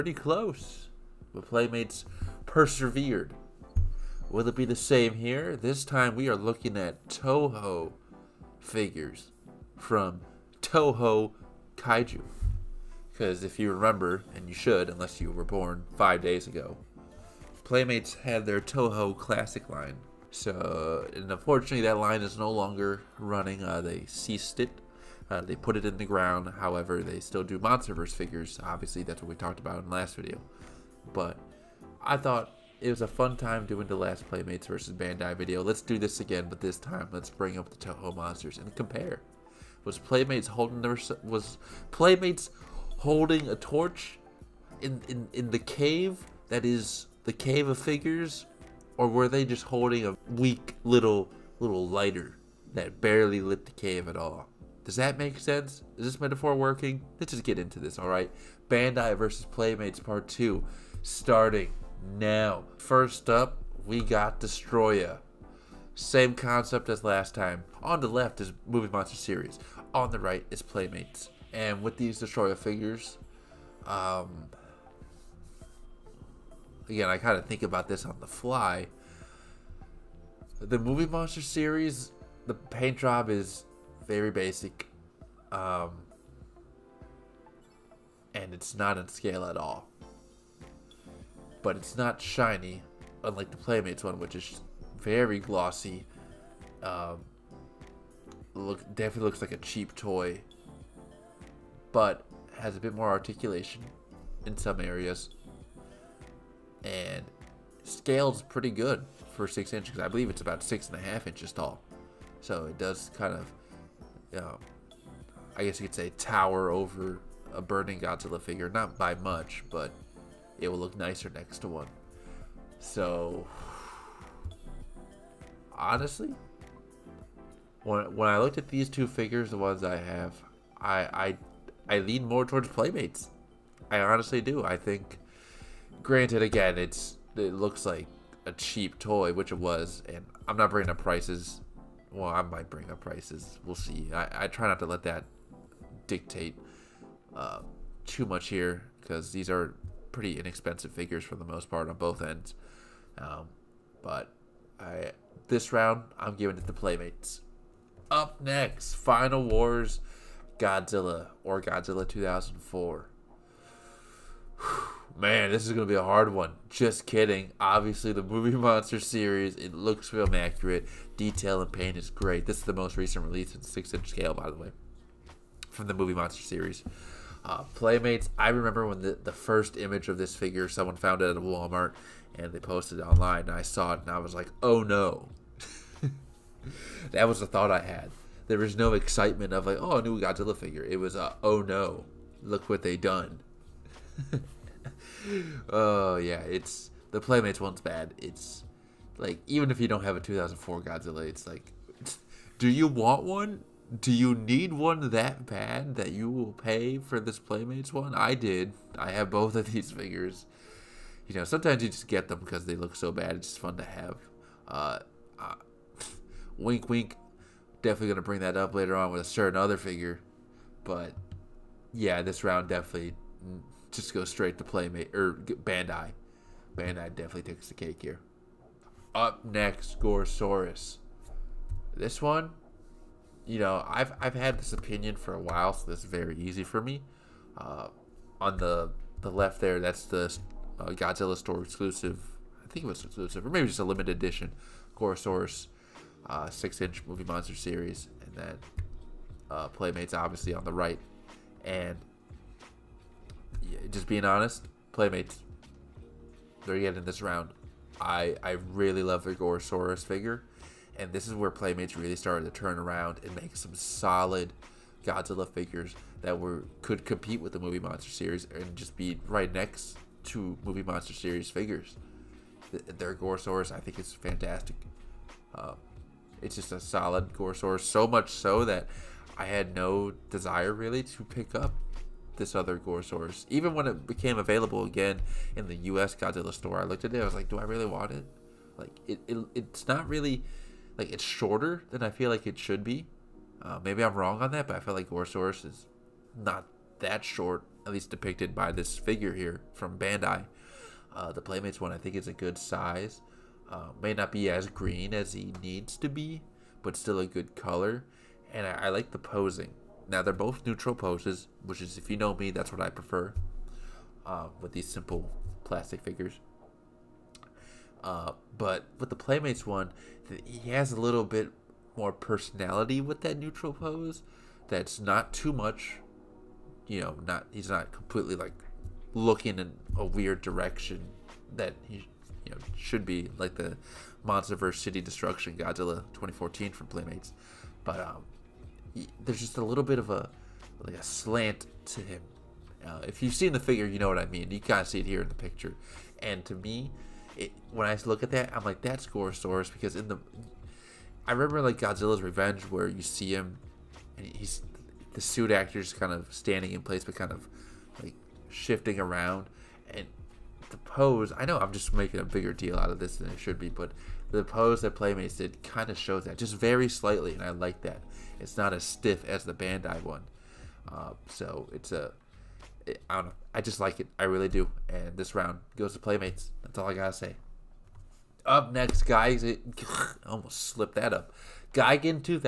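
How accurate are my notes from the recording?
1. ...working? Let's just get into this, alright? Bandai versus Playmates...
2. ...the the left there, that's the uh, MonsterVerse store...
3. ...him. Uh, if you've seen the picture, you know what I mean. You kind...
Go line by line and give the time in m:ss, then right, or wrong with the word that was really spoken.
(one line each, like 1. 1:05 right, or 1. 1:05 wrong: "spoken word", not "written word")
1. 0:56 right
2. 3:58 wrong: "Godzilla", not "MonsterVerse"
3. 5:42 wrong: "figure", not "picture".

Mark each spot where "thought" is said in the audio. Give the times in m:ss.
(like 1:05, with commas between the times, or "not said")
0:32, 3:07.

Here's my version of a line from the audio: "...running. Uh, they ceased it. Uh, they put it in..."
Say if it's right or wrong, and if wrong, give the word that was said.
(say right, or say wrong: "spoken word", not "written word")
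right.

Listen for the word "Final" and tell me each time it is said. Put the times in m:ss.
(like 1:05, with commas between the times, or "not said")
2:38.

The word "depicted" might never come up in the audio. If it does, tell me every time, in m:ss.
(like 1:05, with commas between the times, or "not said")
4:58.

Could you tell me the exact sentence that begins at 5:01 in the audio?
Uh, the Playmates one I think is a good size.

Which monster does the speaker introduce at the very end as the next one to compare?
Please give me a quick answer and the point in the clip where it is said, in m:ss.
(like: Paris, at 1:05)
Gigan, at 6:21.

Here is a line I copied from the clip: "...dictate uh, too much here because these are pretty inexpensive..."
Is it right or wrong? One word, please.
right.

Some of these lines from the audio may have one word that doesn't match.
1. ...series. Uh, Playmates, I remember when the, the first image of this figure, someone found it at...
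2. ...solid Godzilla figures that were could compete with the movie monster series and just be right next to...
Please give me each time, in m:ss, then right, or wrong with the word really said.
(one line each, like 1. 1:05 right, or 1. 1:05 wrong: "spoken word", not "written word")
1. 2:56 right
2. 4:23 right.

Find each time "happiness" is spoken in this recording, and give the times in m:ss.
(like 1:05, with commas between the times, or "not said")
not said.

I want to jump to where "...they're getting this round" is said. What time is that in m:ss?
4:16.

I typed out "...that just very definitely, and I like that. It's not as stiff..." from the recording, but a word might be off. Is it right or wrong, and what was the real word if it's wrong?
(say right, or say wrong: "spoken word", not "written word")
wrong: "slightly", not "definitely".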